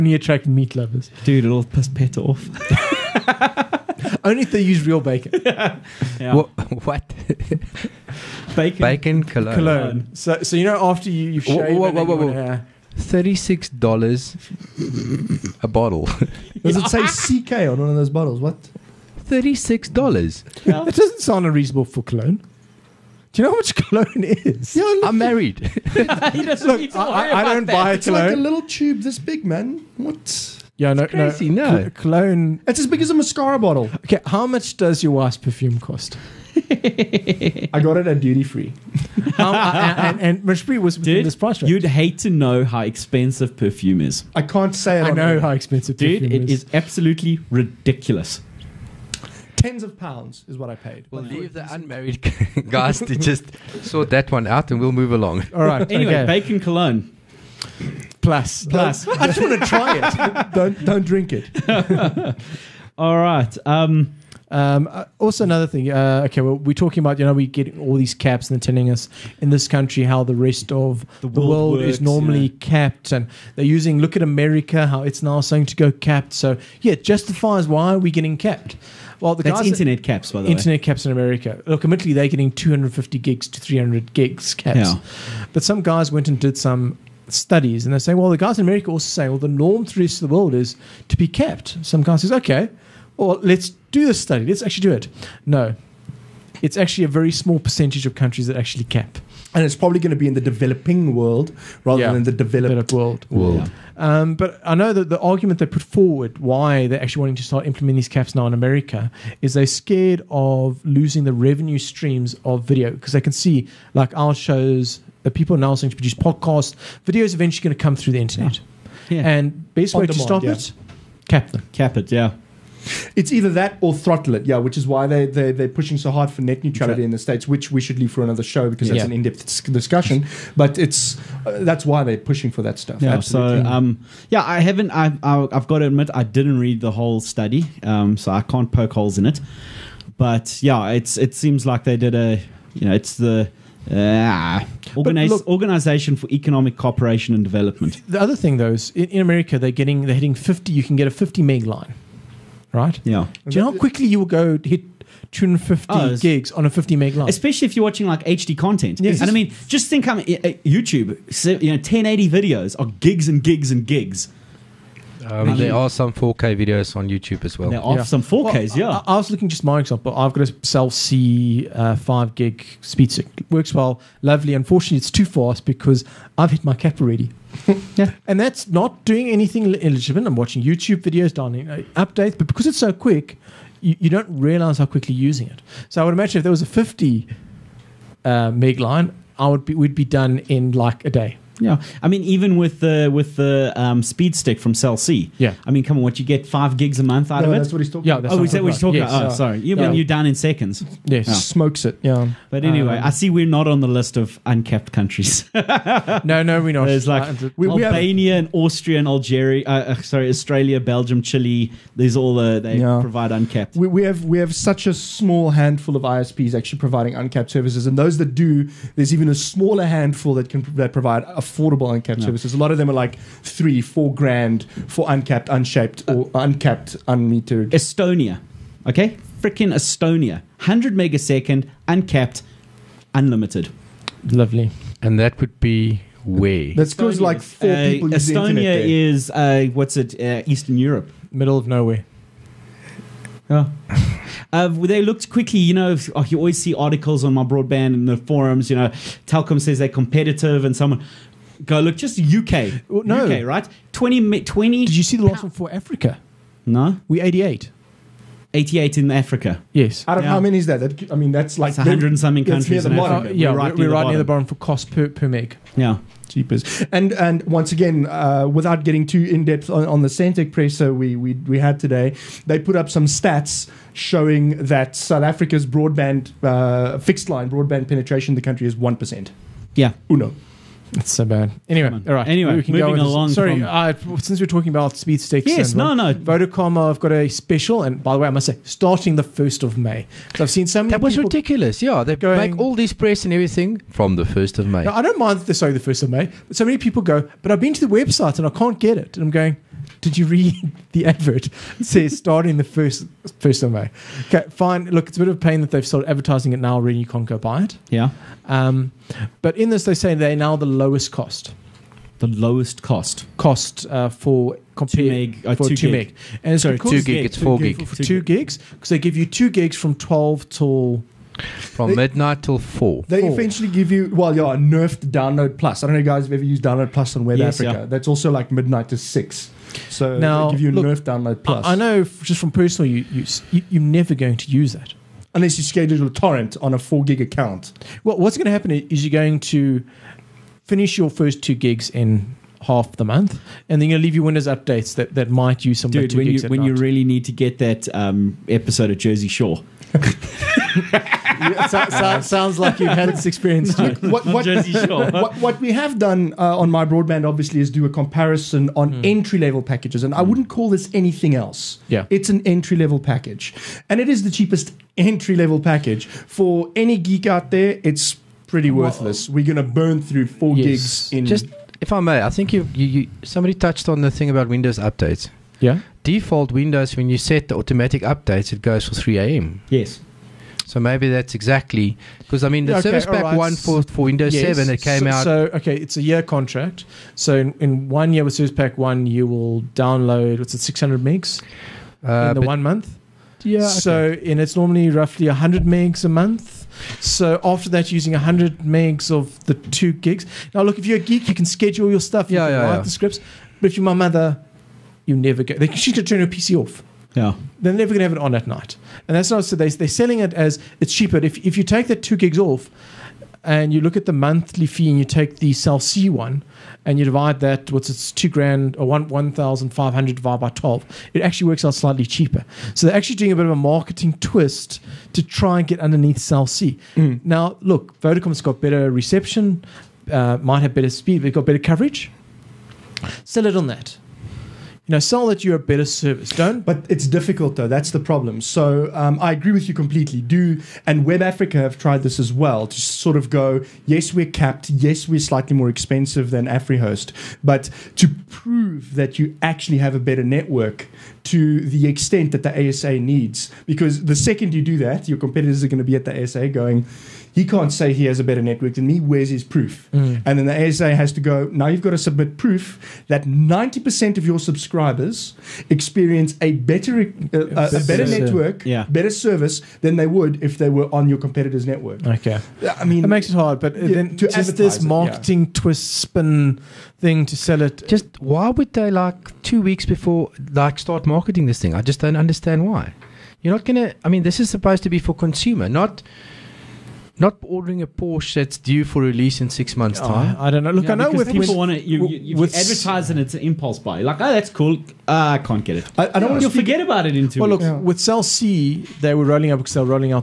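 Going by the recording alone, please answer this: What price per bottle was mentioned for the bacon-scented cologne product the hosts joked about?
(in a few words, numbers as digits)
$36.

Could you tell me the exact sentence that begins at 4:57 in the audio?
But I've been to the website and I can't get it, and I'm going.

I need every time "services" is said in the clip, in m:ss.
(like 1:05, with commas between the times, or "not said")
3:37, 3:42, 6:22, 6:28, 7:15, 7:49.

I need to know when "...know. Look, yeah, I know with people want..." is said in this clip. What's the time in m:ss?
8:10.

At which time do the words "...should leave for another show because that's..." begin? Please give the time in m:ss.
2:07.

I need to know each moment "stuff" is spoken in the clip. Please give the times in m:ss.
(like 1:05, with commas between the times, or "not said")
2:12, 6:42.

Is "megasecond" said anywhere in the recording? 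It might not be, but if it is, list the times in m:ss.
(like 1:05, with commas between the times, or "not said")
3:50.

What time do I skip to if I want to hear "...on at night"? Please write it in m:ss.
6:48.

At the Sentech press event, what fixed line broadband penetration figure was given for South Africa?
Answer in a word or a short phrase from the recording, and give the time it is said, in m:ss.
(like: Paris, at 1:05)
1%, at 4:38.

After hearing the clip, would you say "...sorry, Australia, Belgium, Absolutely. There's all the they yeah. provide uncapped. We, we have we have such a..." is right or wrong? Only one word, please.
wrong.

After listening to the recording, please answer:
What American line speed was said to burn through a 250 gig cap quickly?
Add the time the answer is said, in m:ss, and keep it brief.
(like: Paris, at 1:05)
50 meg, at 2:31.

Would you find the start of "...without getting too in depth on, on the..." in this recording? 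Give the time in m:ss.
4:28.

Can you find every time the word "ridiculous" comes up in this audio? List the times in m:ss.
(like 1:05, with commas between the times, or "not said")
0:47, 4:51.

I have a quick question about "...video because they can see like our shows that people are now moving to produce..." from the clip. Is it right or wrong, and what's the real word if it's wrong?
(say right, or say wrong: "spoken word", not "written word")
wrong: "starting", not "moving".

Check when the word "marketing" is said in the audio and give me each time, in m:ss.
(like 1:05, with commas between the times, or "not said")
7:03, 7:54, 8:01.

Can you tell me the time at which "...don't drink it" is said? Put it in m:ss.
1:00.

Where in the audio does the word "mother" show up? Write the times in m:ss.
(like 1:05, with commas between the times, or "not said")
6:43.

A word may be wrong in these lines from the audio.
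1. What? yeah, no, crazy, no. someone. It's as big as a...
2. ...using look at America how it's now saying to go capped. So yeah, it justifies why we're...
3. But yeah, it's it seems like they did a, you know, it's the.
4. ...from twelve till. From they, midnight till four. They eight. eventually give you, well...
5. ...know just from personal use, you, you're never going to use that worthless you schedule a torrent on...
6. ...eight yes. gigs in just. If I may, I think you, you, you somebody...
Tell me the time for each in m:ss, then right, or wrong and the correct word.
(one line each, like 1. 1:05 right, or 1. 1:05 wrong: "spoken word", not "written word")
1. 0:29 wrong: "cologne", not "someone"
2. 1:13 right
3. 2:20 right
4. 5:19 wrong: "four", not "eight"
5. 5:31 wrong: "unless", not "worthless"
6. 6:10 wrong: "four", not "eight".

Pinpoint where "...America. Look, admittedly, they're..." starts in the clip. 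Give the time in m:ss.
1:21.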